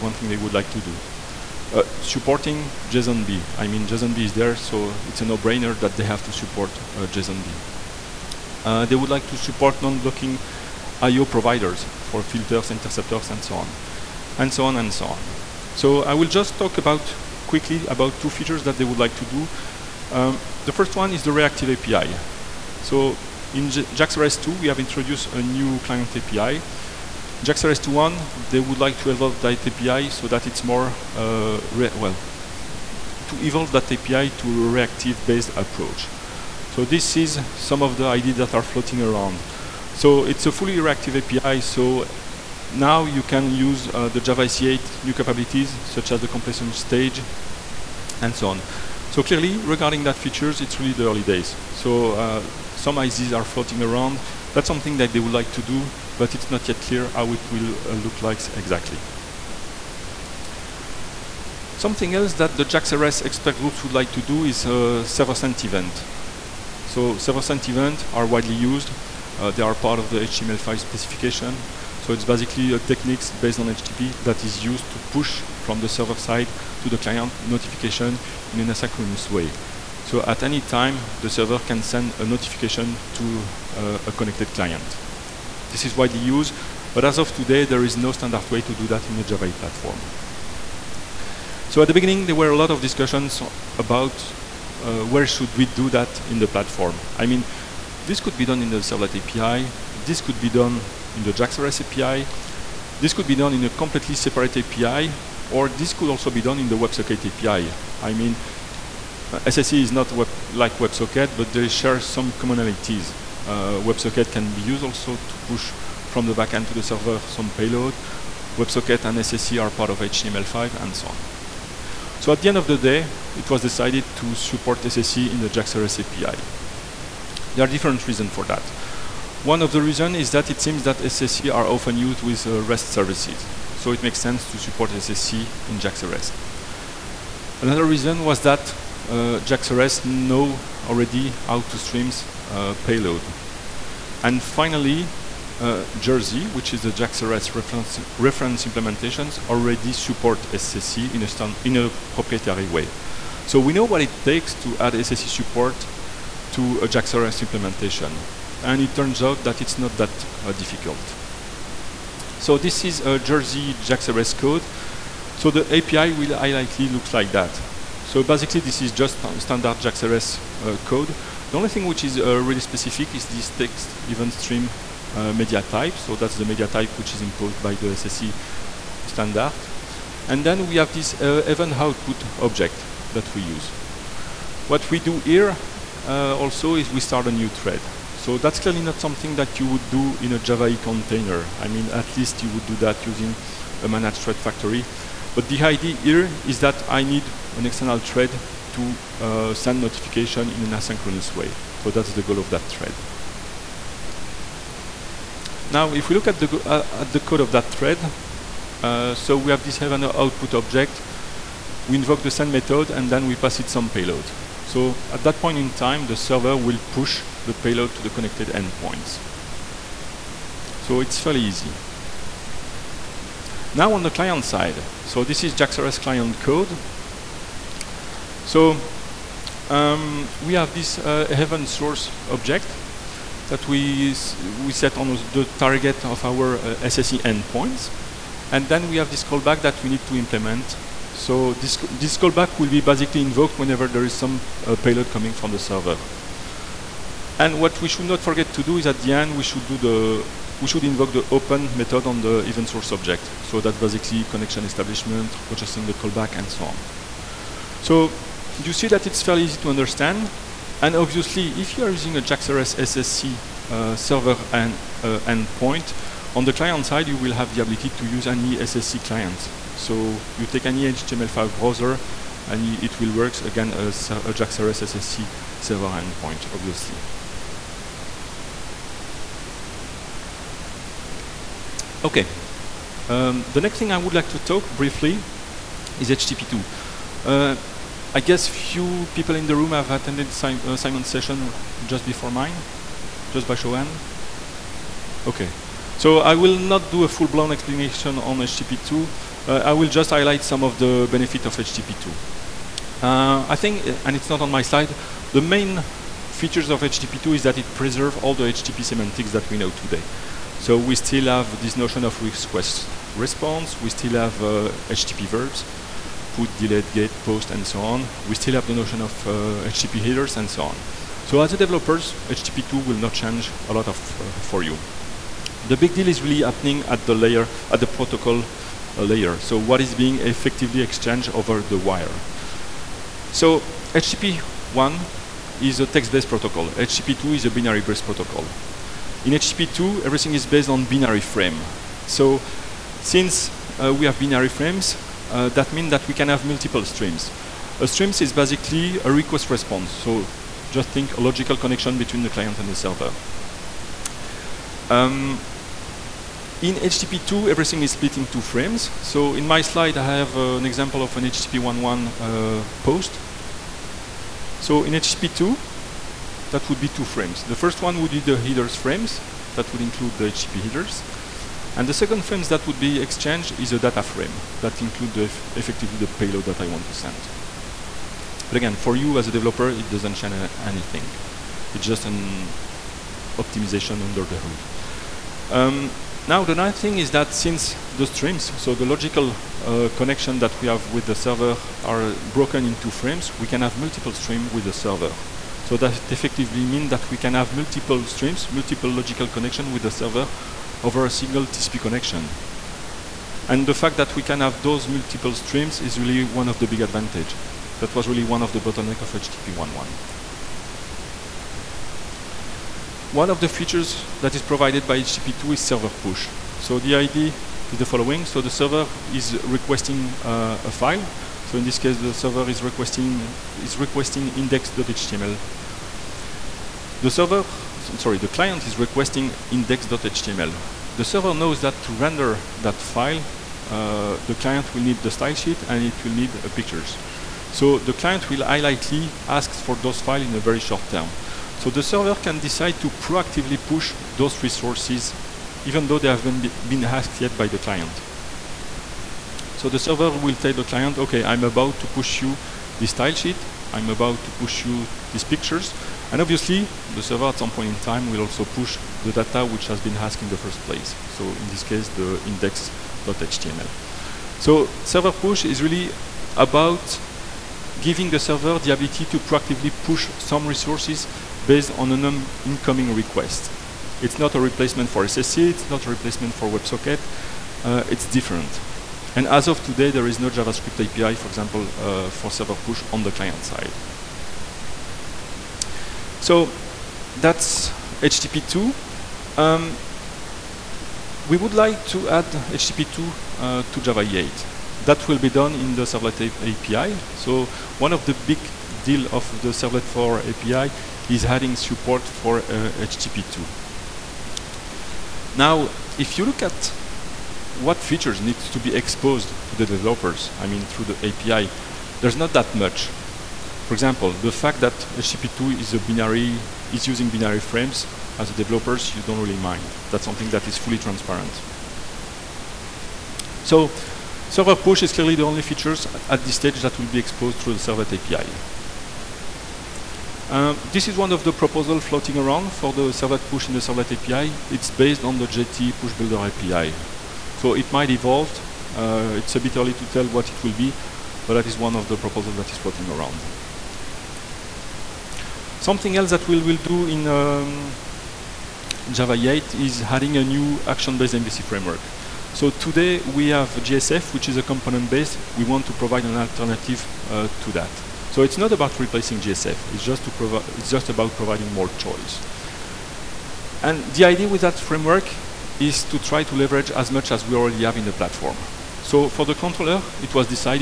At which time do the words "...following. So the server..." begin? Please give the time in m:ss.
6:57.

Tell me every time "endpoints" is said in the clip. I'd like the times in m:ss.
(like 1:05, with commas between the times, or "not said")
3:38, 3:57, 4:25, 4:35.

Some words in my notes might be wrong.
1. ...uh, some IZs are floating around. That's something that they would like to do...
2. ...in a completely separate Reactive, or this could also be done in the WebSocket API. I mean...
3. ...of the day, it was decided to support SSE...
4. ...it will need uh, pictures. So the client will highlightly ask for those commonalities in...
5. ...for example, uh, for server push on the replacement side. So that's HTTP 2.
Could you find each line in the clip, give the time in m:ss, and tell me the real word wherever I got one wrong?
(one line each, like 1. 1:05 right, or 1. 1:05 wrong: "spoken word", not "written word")
1. 0:52 right
2. 1:43 wrong: "API", not "Reactive"
3. 2:02 right
4. 7:15 wrong: "files", not "commonalities"
5. 8:01 wrong: "client", not "replacement".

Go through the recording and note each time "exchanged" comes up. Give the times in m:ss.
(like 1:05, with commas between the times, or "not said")
5:30, 6:13.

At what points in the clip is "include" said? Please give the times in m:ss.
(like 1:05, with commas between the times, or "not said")
6:09, 6:14.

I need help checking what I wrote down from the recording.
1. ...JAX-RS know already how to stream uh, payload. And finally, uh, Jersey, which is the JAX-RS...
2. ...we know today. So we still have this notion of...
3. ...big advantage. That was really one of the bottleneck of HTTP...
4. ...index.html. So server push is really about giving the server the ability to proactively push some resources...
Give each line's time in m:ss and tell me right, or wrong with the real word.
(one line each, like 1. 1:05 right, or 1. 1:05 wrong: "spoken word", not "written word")
1. 2:19 right
2. 5:09 right
3. 6:46 right
4. 7:42 right.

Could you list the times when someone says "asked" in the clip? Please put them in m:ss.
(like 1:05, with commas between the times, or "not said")
7:26, 7:39.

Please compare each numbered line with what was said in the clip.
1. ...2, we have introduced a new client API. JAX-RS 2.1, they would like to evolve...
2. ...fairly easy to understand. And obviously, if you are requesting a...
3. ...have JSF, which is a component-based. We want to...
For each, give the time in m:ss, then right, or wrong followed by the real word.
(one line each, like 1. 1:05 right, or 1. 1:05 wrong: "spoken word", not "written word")
1. 0:24 right
2. 4:19 wrong: "using", not "requesting"
3. 9:13 right.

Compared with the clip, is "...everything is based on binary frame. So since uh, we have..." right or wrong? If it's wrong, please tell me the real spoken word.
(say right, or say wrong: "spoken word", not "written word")
right.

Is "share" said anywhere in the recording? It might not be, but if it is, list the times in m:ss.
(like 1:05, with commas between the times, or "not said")
1:51.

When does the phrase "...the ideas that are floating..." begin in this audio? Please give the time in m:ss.
0:37.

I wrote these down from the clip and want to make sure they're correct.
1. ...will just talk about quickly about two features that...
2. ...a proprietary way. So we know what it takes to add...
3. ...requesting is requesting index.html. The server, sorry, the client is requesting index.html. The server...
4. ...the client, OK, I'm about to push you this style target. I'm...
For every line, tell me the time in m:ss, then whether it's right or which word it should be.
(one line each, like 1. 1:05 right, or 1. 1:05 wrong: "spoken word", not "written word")
1. 0:16 right
2. 2:31 right
3. 7:02 right
4. 7:30 wrong: "sheet", not "target".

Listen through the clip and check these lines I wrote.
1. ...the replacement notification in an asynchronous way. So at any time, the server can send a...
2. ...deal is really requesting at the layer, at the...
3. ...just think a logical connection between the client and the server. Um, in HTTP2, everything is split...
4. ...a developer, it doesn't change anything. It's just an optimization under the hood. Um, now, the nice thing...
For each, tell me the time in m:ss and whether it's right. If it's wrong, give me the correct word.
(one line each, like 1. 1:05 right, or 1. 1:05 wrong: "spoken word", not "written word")
1. 1:16 wrong: "client", not "replacement"
2. 5:25 wrong: "happening", not "requesting"
3. 5:50 right
4. 6:19 right.